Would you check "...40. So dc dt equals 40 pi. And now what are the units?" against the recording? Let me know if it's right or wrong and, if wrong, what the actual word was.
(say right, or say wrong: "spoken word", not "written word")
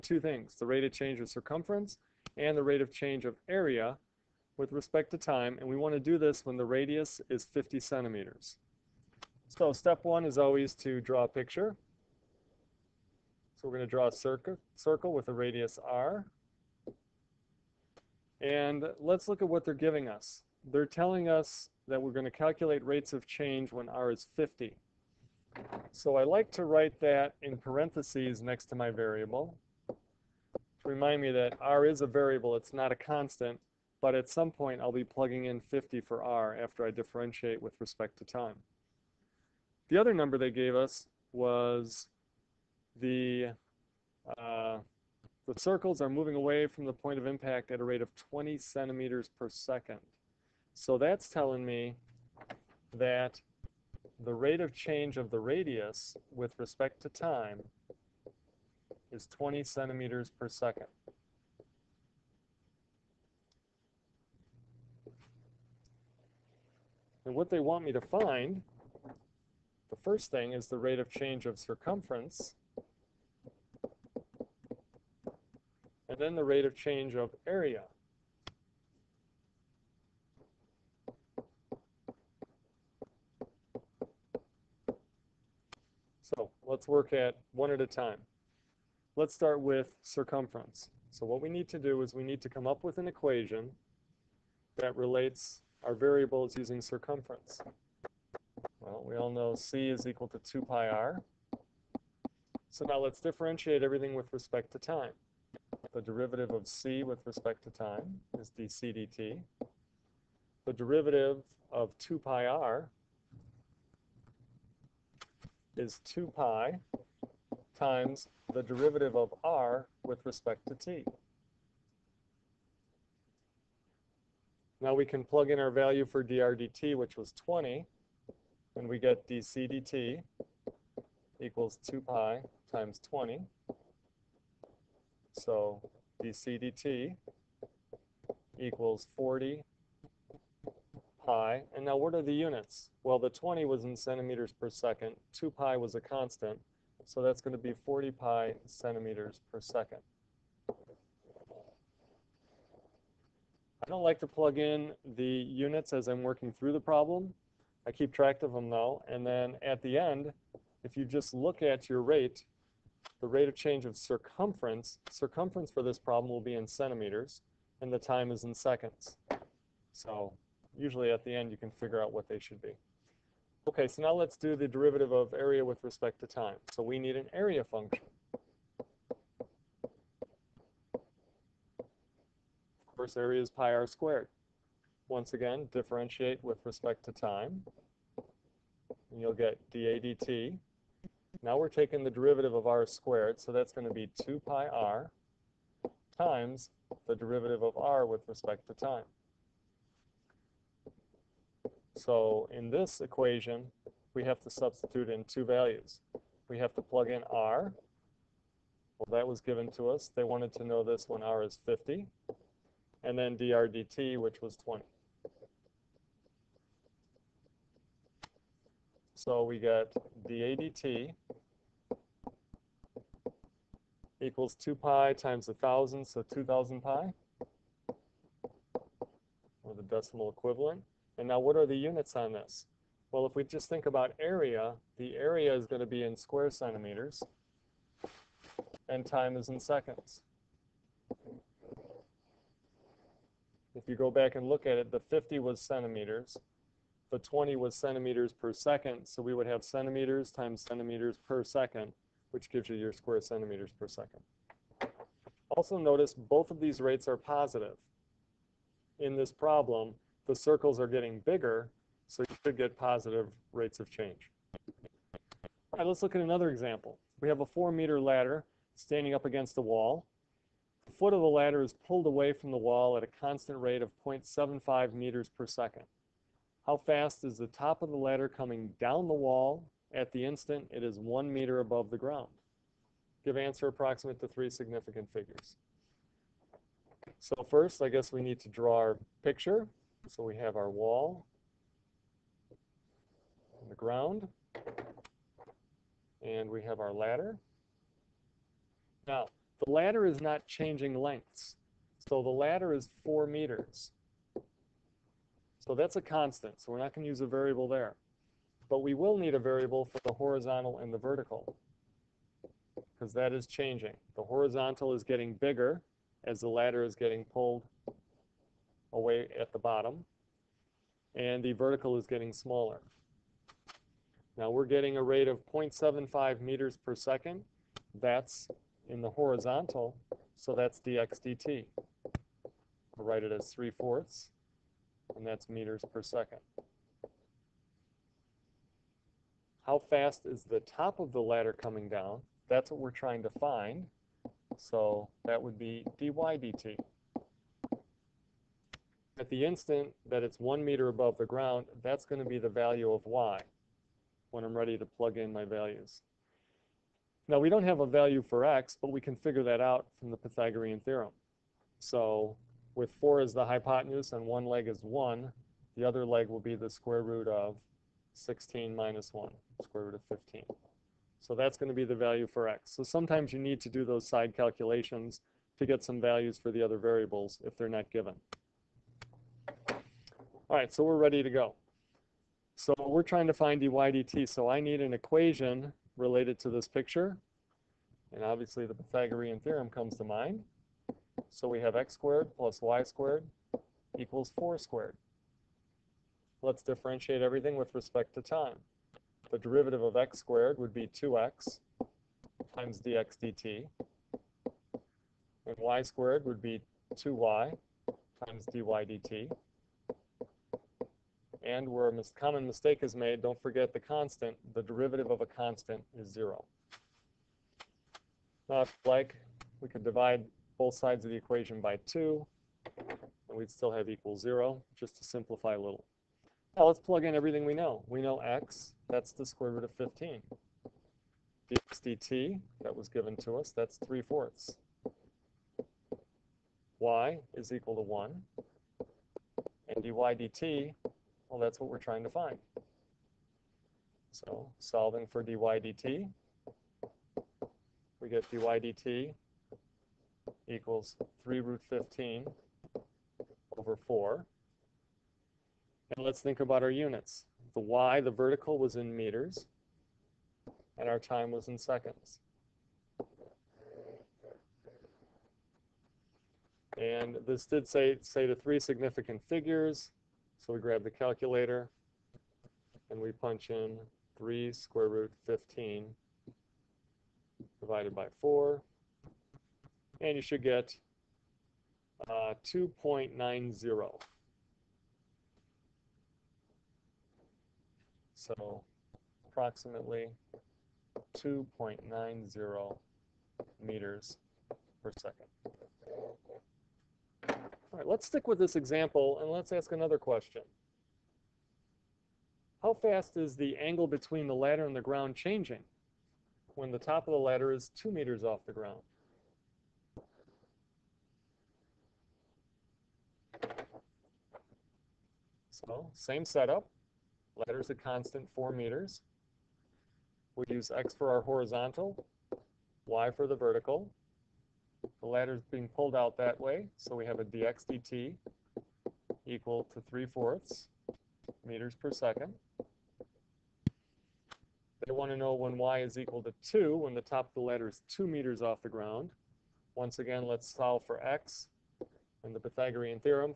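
wrong: "20", not "40".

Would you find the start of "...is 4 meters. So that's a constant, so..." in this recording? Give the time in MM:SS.
05:02.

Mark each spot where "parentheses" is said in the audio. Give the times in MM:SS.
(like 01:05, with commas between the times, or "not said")
00:27.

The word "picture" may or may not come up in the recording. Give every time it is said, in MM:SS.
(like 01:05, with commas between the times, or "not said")
00:11, 04:49, 06:26.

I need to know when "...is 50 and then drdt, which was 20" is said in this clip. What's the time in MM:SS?
03:31.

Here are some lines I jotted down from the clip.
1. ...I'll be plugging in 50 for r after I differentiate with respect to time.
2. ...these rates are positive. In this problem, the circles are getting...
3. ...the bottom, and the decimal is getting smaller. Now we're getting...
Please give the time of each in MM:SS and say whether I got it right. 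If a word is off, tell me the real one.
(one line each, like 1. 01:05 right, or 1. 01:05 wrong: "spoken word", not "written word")
1. 00:34 right
2. 04:16 right
3. 05:19 wrong: "vertical", not "decimal".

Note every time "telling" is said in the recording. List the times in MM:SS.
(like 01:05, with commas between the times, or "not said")
00:20, 00:51.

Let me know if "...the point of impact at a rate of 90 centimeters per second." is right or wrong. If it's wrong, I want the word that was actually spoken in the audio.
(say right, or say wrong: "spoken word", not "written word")
wrong: "20", not "90".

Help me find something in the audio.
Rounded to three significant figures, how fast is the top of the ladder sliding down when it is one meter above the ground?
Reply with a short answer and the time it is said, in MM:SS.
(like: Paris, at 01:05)
2.90 meters per second, at 08:11.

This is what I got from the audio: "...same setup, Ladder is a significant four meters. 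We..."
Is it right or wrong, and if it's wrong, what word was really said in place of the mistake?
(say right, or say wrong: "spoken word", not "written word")
wrong: "constant", not "significant".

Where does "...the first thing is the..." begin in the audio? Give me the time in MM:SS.
01:09.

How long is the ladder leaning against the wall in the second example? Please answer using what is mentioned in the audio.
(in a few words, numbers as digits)
4 meters.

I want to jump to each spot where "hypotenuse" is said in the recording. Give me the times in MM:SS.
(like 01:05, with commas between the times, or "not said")
06:03.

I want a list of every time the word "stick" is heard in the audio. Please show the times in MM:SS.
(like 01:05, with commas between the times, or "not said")
08:18.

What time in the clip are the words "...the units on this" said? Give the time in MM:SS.
03:51.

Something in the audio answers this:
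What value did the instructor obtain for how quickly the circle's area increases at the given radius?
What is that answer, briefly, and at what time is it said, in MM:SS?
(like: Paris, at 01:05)
2,000 pi, at 03:46.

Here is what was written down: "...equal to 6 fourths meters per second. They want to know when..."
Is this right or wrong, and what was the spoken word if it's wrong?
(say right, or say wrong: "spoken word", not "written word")
wrong: "3", not "6".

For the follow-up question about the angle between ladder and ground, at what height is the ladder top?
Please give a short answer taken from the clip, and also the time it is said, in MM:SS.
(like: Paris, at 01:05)
2 meters, at 08:27.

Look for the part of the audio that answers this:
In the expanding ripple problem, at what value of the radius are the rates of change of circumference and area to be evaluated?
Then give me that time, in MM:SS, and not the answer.
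00:07.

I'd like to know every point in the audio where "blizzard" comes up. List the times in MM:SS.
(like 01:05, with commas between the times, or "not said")
not said.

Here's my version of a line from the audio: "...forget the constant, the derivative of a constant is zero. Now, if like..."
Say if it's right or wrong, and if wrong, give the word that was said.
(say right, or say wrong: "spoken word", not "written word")
right.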